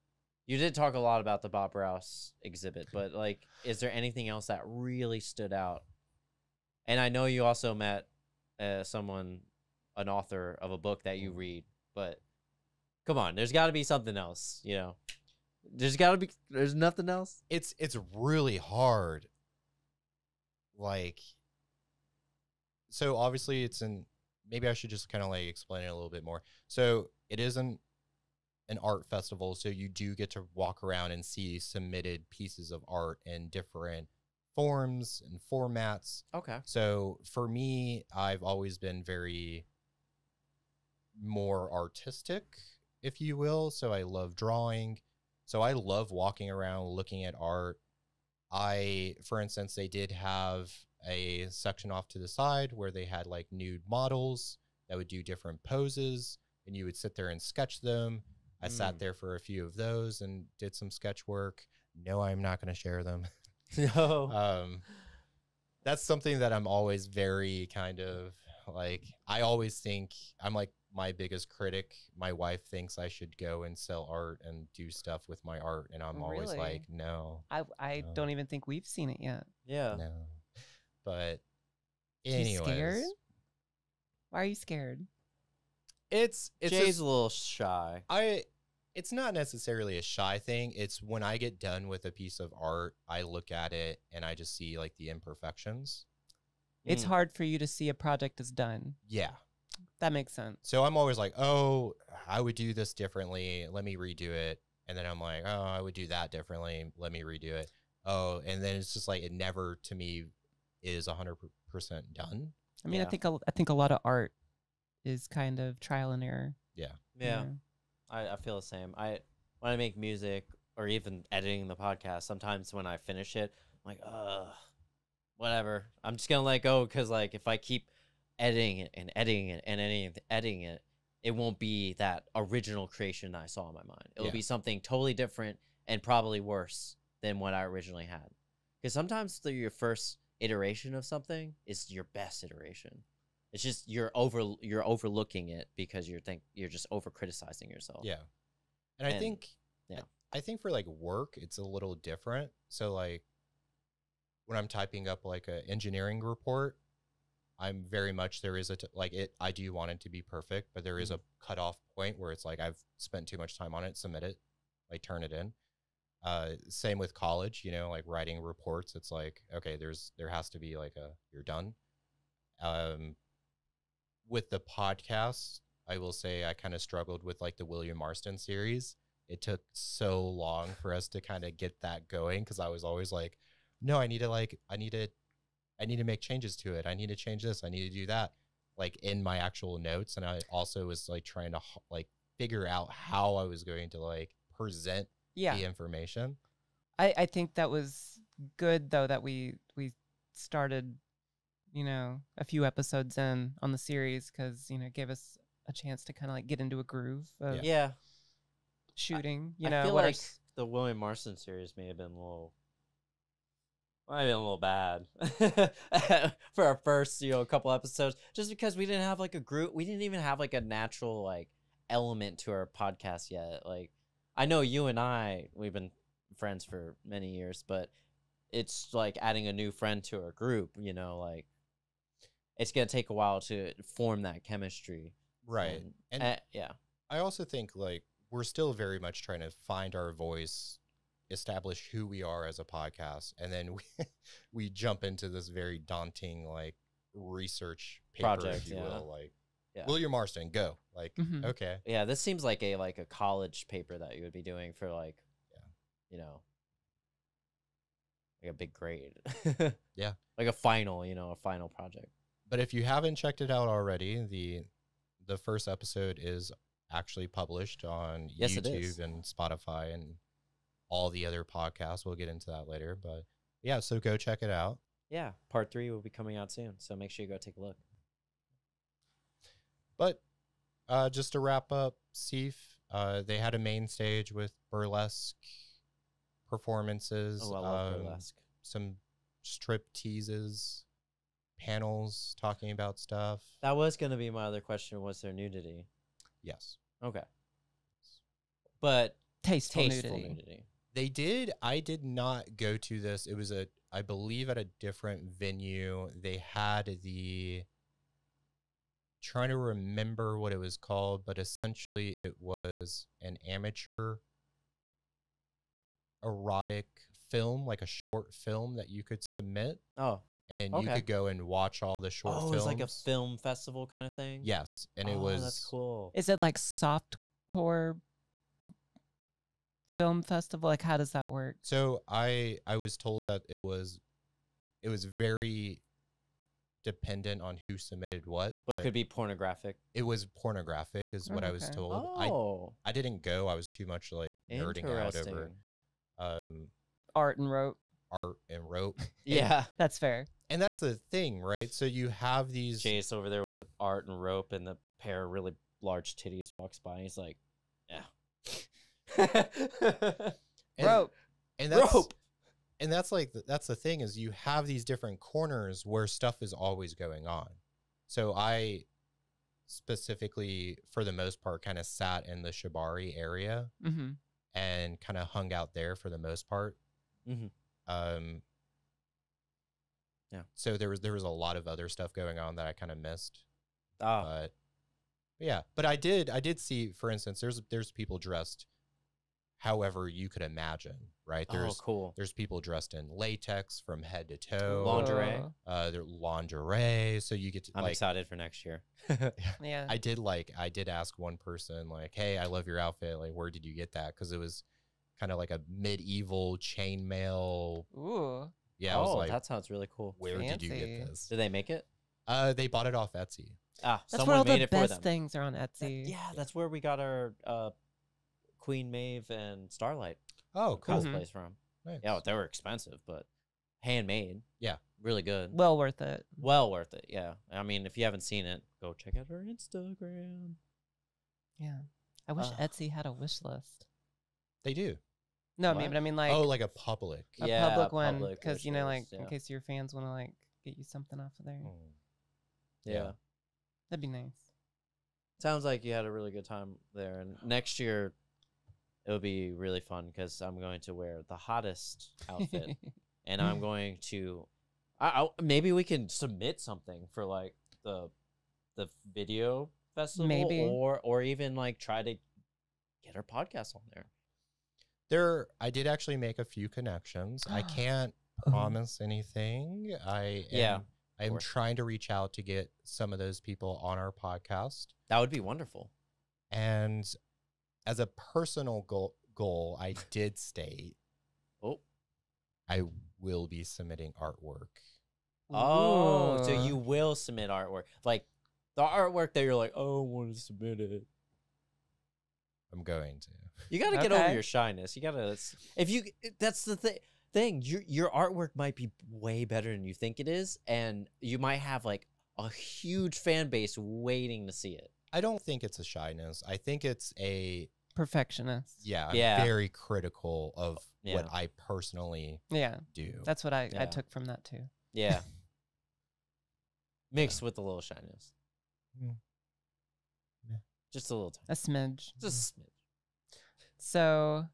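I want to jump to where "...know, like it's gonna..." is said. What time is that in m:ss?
3:50.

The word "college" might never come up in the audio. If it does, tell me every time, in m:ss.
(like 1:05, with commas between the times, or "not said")
2:47, 4:13.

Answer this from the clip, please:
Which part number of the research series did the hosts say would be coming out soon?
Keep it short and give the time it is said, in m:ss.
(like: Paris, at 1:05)
3, at 4:35.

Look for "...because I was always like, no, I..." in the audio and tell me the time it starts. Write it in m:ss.
3:02.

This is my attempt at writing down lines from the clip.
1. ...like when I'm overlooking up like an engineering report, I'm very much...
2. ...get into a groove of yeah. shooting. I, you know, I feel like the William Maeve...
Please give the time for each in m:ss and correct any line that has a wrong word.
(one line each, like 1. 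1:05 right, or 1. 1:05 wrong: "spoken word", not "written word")
1. 2:32 wrong: "typing", not "overlooking"
2. 3:26 wrong: "Marston", not "Maeve".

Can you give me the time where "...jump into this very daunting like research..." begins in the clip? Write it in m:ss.
4:04.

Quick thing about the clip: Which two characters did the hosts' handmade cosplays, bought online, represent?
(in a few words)
Queen Maeve and Starlight.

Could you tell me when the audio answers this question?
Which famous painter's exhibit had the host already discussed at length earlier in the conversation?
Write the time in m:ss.
0:01.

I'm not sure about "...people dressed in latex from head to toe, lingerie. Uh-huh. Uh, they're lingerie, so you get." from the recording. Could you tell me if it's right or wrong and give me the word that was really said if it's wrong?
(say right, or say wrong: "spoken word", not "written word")
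right.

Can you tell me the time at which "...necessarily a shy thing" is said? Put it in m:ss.
1:29.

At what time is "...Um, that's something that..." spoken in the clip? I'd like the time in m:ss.
1:04.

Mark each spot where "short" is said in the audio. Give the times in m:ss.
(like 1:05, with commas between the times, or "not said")
5:17, 5:22.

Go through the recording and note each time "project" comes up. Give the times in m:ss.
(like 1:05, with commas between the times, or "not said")
1:37, 4:08, 4:21.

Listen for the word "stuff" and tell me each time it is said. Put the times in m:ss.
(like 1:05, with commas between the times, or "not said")
1:14, 4:52, 6:06, 6:21.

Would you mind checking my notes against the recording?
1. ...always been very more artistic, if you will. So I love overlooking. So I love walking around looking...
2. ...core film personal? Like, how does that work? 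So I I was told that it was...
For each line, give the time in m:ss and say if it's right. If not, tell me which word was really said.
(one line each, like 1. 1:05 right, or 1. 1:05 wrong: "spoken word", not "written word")
1. 0:38 wrong: "drawing", not "overlooking"
2. 5:27 wrong: "festival", not "personal".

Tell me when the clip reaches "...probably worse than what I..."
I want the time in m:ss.
2:16.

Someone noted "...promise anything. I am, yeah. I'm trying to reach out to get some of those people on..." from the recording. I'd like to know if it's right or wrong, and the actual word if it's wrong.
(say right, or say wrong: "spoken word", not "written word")
right.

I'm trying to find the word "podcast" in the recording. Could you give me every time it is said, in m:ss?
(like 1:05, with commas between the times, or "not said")
2:01, 2:54, 3:42, 4:02, 4:31, 7:43, 7:54.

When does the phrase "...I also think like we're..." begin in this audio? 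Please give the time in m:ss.
3:57.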